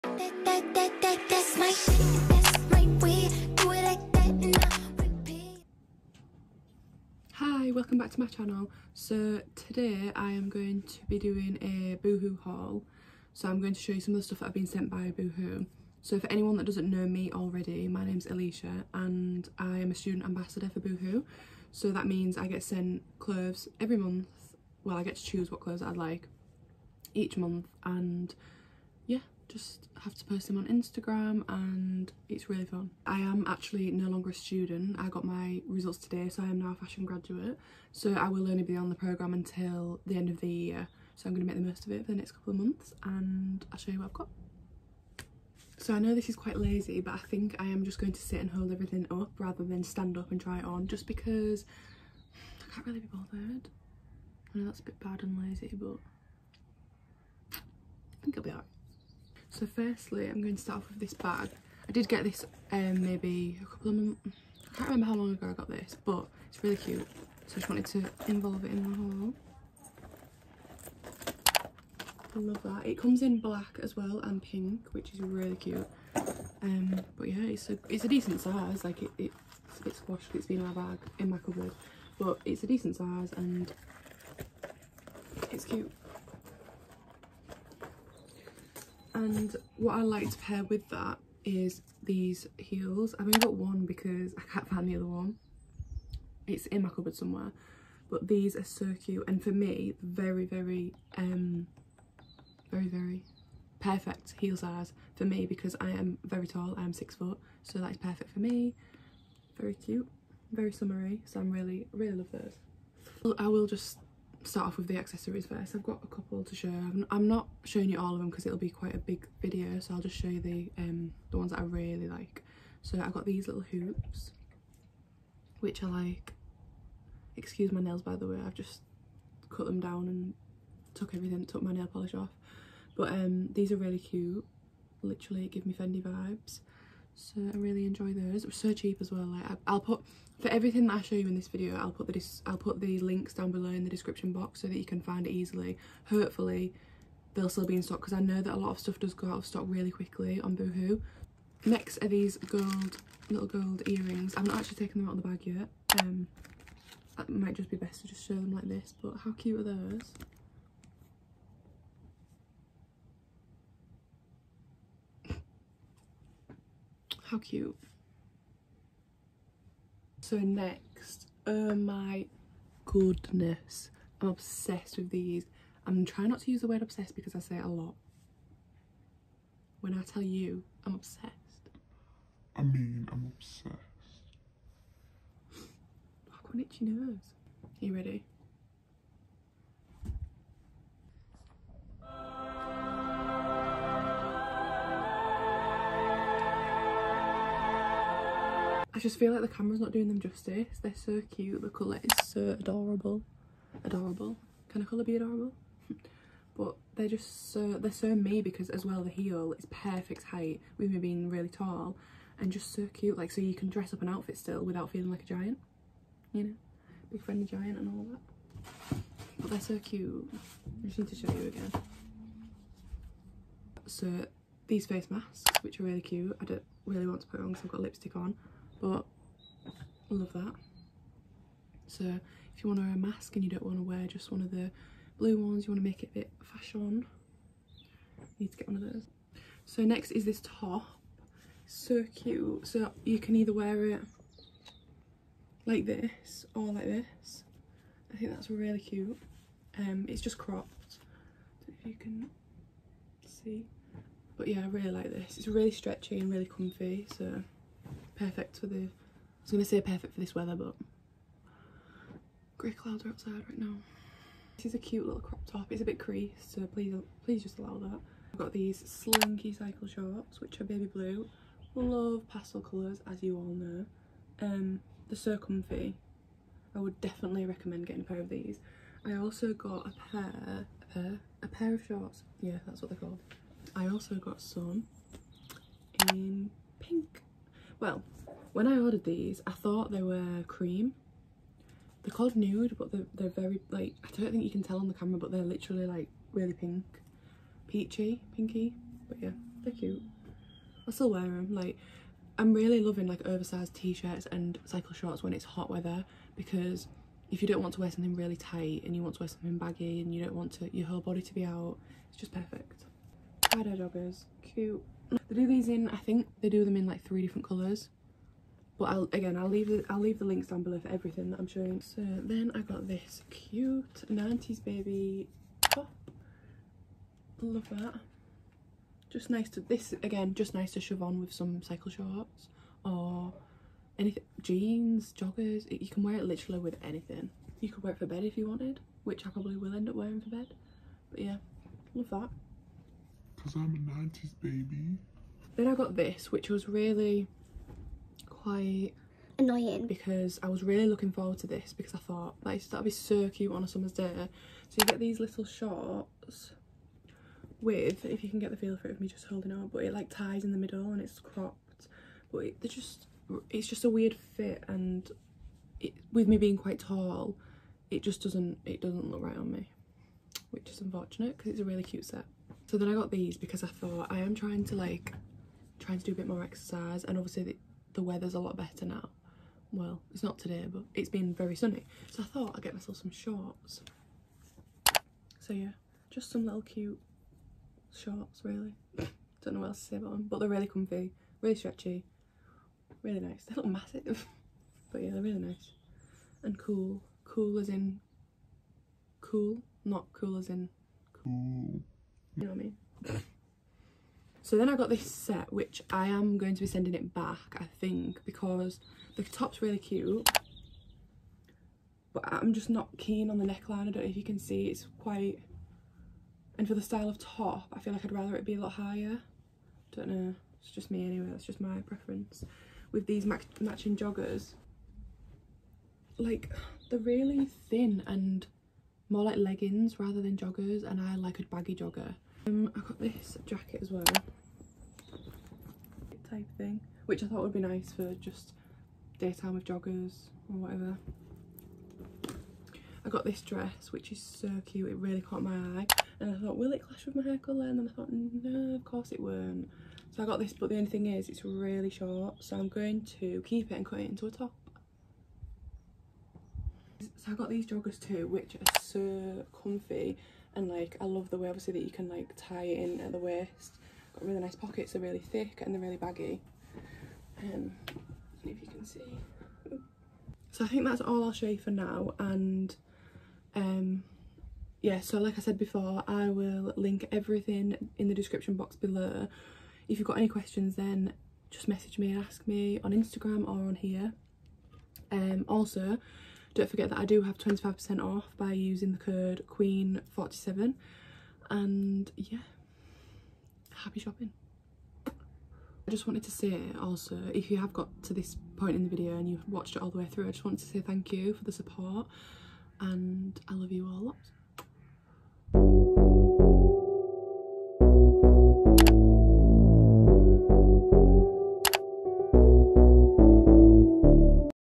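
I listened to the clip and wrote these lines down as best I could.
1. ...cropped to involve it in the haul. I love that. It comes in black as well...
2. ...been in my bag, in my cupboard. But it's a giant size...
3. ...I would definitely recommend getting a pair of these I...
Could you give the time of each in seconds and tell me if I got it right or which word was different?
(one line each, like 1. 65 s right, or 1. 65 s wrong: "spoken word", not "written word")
1. 67 s wrong: "wanted", not "cropped"
2. 80 s wrong: "decent", not "giant"
3. 276 s right.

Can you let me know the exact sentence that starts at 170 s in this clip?
So next, oh my goodness, I'm obsessed with these.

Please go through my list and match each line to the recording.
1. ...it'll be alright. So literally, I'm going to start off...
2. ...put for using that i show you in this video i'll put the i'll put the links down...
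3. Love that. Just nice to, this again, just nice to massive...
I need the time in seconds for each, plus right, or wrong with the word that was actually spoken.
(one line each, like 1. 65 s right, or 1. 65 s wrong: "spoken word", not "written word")
1. 58 s wrong: "firstly", not "literally"
2. 139 s wrong: "everything", not "using"
3. 327 s wrong: "shove", not "massive".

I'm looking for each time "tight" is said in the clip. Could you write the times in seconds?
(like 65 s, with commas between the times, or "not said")
308 s.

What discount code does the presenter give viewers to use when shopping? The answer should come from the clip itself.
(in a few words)
QUEEN47.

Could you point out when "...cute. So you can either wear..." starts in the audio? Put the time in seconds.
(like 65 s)
242 s.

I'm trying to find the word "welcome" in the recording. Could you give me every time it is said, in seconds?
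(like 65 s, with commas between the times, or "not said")
7 s.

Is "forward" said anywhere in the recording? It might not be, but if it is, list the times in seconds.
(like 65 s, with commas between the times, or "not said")
351 s.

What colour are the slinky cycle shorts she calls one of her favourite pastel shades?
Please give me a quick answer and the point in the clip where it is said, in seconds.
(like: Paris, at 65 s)
Baby blue, at 270 s.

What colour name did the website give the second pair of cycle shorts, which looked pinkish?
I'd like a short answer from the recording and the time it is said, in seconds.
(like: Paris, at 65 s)
Nude, at 292 s.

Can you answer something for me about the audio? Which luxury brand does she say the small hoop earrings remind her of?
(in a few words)
Fendi.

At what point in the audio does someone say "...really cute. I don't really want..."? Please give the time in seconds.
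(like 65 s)
225 s.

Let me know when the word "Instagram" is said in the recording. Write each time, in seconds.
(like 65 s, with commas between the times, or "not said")
30 s, 482 s.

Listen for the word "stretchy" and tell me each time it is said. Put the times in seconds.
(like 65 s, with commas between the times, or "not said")
255 s, 391 s.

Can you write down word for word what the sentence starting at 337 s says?
You could wear it for bed if you wanted, which I probably will end up wearing for bed.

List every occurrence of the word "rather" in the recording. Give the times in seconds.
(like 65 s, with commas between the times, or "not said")
49 s, 418 s, 429 s.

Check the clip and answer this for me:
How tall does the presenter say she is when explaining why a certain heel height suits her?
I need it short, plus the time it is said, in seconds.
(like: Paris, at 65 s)
6 foot, at 106 s.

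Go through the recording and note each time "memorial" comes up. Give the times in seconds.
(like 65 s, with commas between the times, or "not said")
not said.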